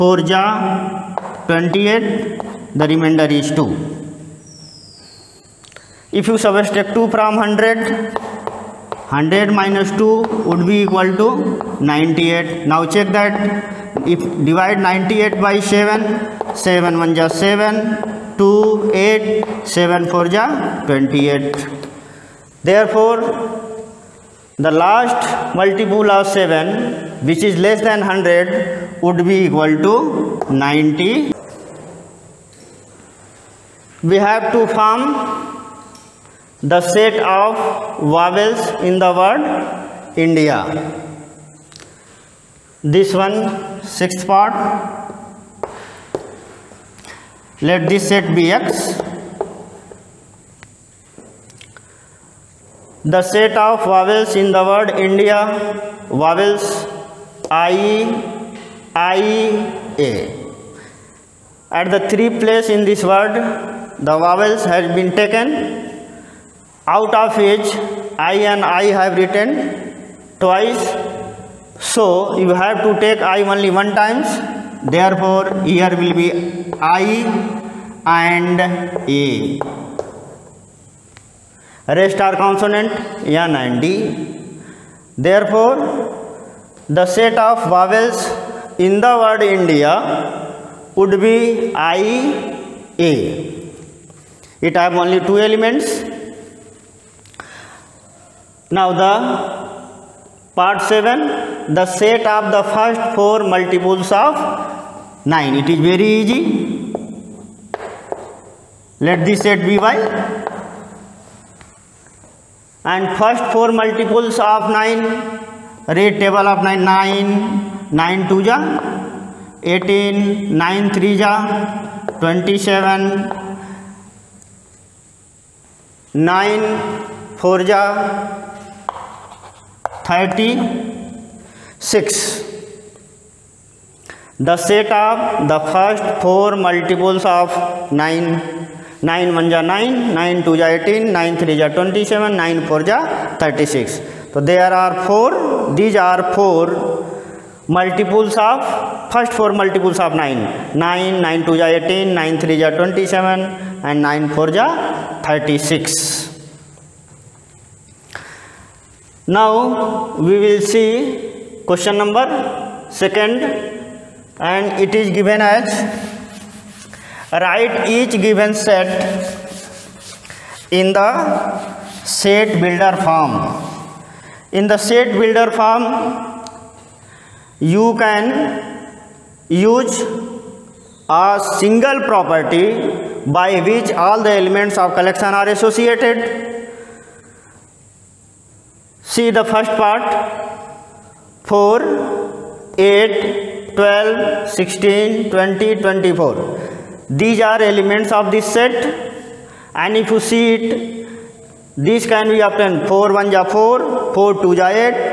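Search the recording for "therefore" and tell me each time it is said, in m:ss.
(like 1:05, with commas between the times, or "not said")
0:22, 1:14, 1:25.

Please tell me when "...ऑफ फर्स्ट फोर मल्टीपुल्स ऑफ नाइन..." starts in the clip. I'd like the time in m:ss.
2:28.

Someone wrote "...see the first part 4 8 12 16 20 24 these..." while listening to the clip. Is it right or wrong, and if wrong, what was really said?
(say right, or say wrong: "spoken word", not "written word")
right.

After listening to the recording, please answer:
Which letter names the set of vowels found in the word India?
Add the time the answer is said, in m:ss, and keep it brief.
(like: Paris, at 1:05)
X, at 0:48.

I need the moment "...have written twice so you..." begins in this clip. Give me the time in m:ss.
1:09.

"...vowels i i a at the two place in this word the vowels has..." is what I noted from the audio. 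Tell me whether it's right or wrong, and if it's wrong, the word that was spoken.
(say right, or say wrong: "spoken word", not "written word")
wrong: "three", not "two".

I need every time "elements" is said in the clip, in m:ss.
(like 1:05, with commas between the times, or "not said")
1:35, 3:04, 3:17.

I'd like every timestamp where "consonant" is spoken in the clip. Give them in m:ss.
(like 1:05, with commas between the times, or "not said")
1:22.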